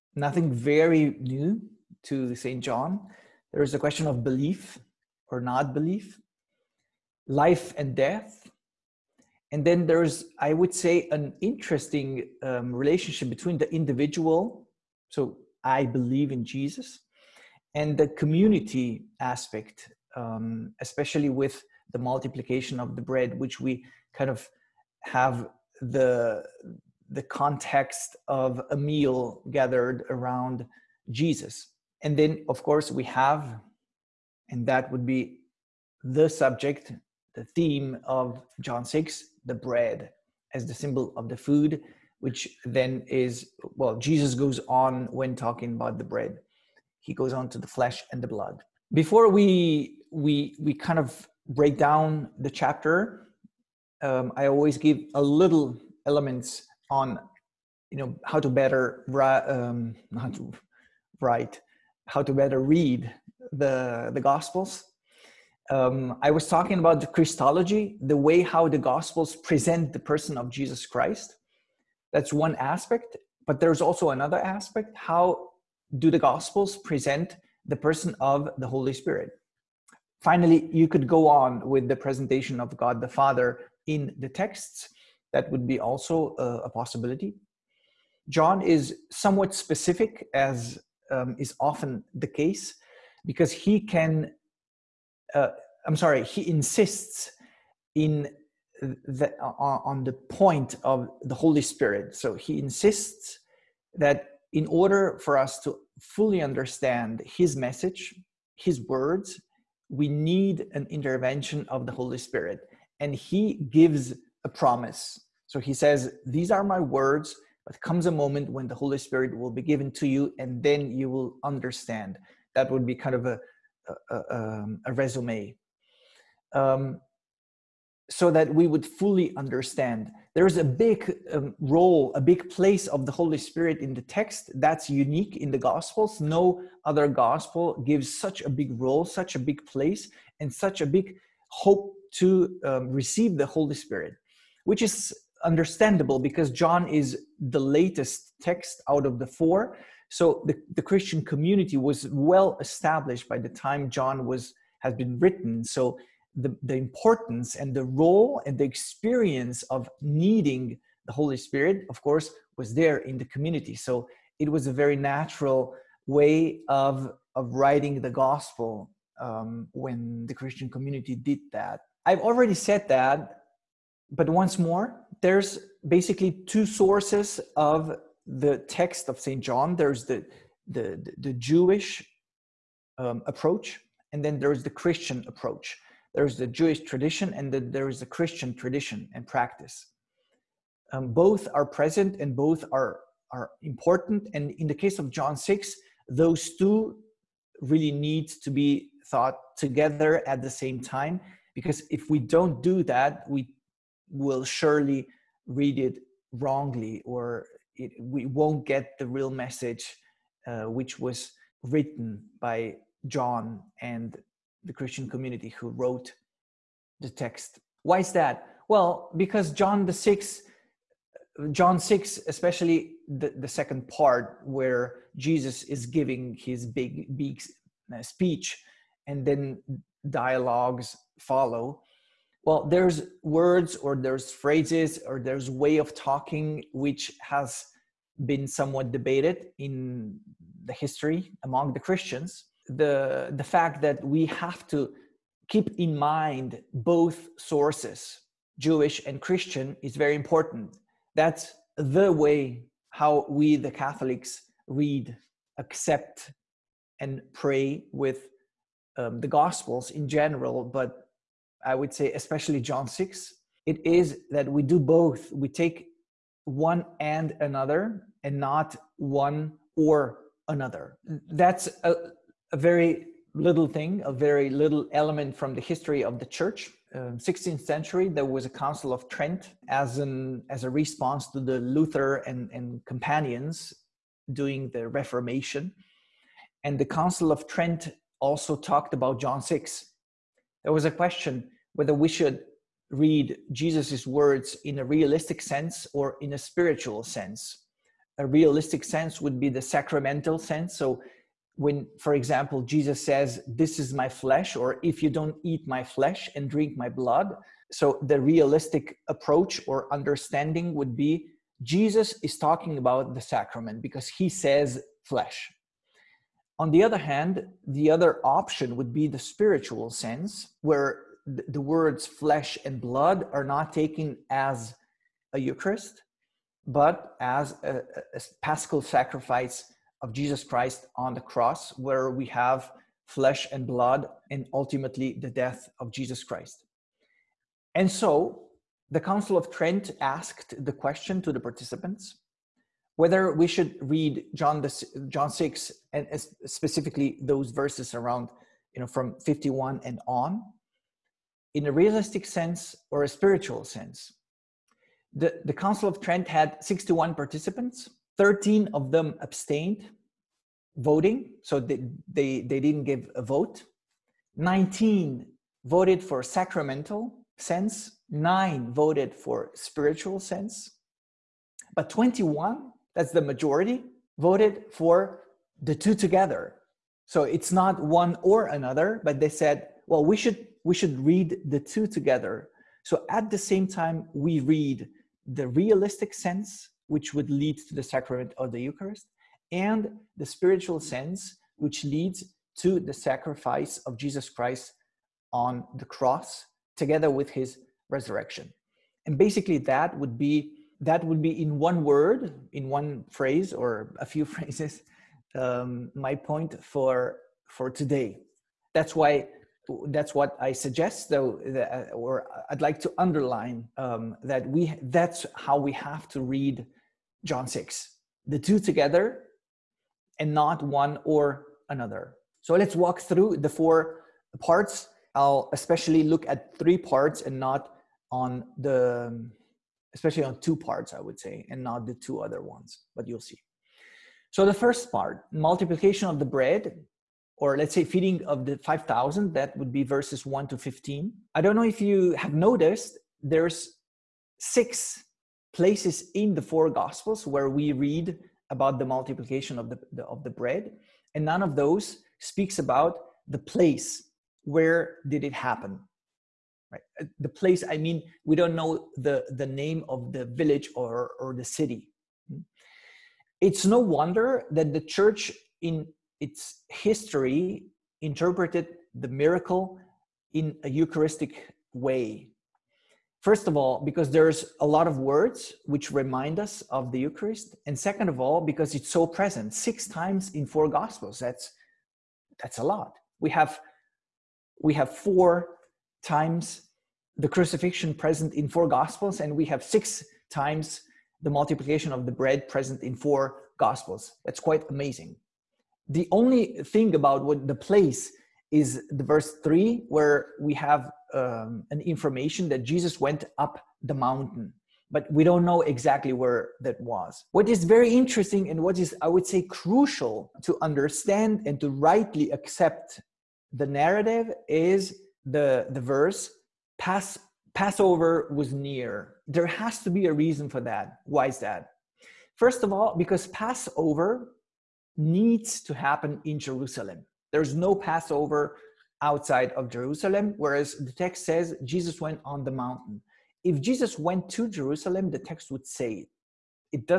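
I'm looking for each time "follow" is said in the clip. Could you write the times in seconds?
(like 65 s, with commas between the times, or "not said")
231 s.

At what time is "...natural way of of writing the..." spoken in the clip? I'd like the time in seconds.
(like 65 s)
164 s.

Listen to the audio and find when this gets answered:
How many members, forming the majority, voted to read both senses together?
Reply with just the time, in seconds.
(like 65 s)
371 s.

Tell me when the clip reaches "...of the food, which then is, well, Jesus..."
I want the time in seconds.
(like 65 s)
41 s.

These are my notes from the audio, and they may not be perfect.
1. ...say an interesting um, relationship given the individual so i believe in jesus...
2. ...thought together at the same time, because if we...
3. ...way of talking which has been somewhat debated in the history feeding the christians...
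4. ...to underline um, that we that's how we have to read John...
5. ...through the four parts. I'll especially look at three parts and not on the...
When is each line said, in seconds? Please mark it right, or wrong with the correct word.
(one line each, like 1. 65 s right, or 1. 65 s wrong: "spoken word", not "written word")
1. 10 s wrong: "between", not "given"
2. 199 s right
3. 235 s wrong: "among", not "feeding"
4. 412 s right
5. 423 s right.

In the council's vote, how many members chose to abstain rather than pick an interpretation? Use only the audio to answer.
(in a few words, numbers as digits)
13.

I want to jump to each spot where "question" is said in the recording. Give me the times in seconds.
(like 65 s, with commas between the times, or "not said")
3 s, 290 s, 340 s.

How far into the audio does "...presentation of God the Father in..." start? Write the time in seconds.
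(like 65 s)
81 s.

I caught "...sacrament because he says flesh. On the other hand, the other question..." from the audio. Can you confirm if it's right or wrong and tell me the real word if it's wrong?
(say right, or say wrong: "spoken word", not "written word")
wrong: "option", not "question".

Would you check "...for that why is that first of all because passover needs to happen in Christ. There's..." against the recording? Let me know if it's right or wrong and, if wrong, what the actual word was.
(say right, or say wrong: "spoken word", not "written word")
wrong: "Jerusalem", not "Christ".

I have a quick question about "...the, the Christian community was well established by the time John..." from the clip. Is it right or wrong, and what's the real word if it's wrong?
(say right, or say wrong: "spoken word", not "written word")
right.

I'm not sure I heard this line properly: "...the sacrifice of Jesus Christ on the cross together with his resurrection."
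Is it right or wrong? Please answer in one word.
right.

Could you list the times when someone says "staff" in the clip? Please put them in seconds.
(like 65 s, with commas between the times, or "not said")
not said.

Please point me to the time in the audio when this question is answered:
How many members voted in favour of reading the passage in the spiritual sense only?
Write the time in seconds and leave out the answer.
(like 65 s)
368 s.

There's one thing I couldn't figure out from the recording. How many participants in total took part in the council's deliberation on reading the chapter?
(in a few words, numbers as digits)
61.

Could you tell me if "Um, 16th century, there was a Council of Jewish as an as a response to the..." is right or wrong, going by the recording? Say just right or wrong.
wrong.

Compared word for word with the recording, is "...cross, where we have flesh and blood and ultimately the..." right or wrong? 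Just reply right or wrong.
right.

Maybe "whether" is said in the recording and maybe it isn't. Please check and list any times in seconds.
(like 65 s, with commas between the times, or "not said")
291 s, 342 s.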